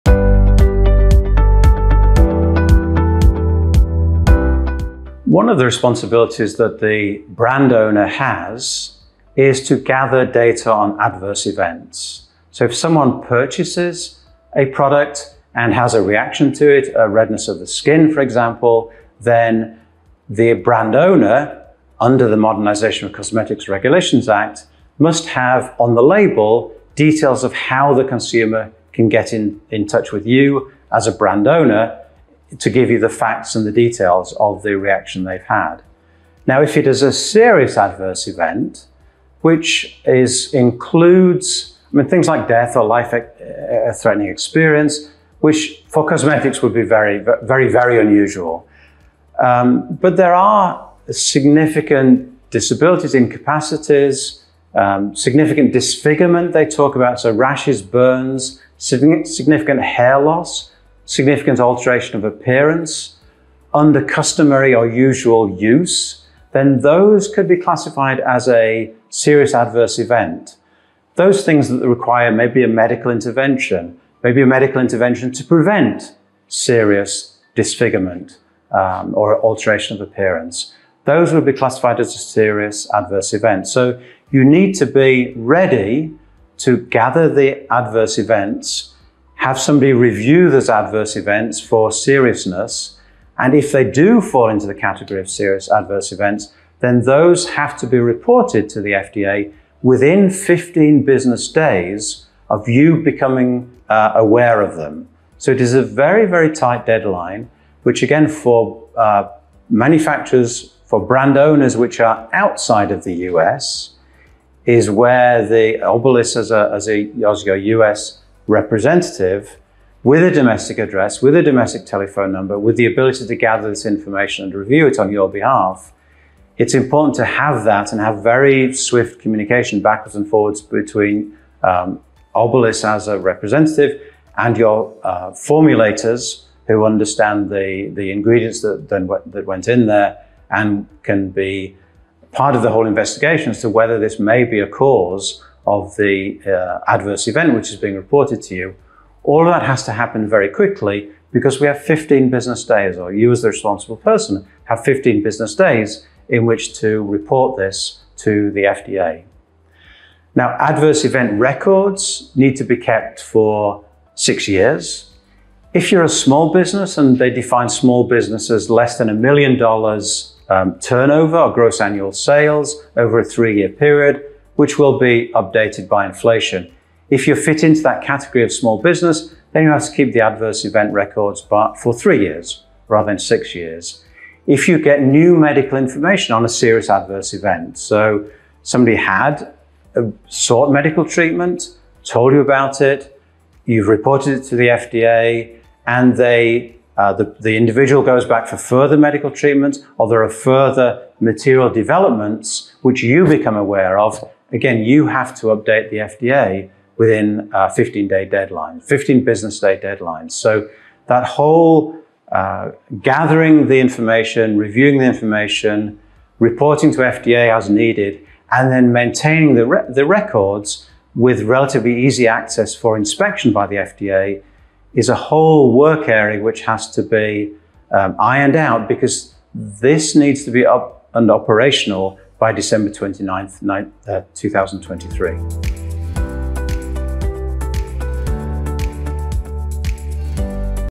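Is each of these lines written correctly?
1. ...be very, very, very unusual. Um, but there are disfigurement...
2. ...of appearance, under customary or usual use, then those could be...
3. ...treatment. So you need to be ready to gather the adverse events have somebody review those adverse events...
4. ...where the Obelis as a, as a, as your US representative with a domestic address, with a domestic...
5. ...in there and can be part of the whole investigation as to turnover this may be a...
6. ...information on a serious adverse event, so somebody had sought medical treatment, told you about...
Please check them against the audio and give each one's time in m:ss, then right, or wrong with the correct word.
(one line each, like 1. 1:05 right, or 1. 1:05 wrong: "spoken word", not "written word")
1. 0:46 wrong: "significant", not "disfigurement"
2. 1:02 right
3. 1:23 wrong: "event", not "treatment"
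4. 1:54 right
5. 2:19 wrong: "whether", not "turnover"
6. 3:05 right.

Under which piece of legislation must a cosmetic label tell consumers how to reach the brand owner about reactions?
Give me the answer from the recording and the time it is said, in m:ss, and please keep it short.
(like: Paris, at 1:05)
Modernisation of Cosmetics Regulations Act, at 0:22.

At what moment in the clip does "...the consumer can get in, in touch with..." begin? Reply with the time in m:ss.
0:27.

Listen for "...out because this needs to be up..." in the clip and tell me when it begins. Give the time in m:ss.
3:48.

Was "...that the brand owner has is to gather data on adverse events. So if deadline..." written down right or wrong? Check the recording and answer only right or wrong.
wrong.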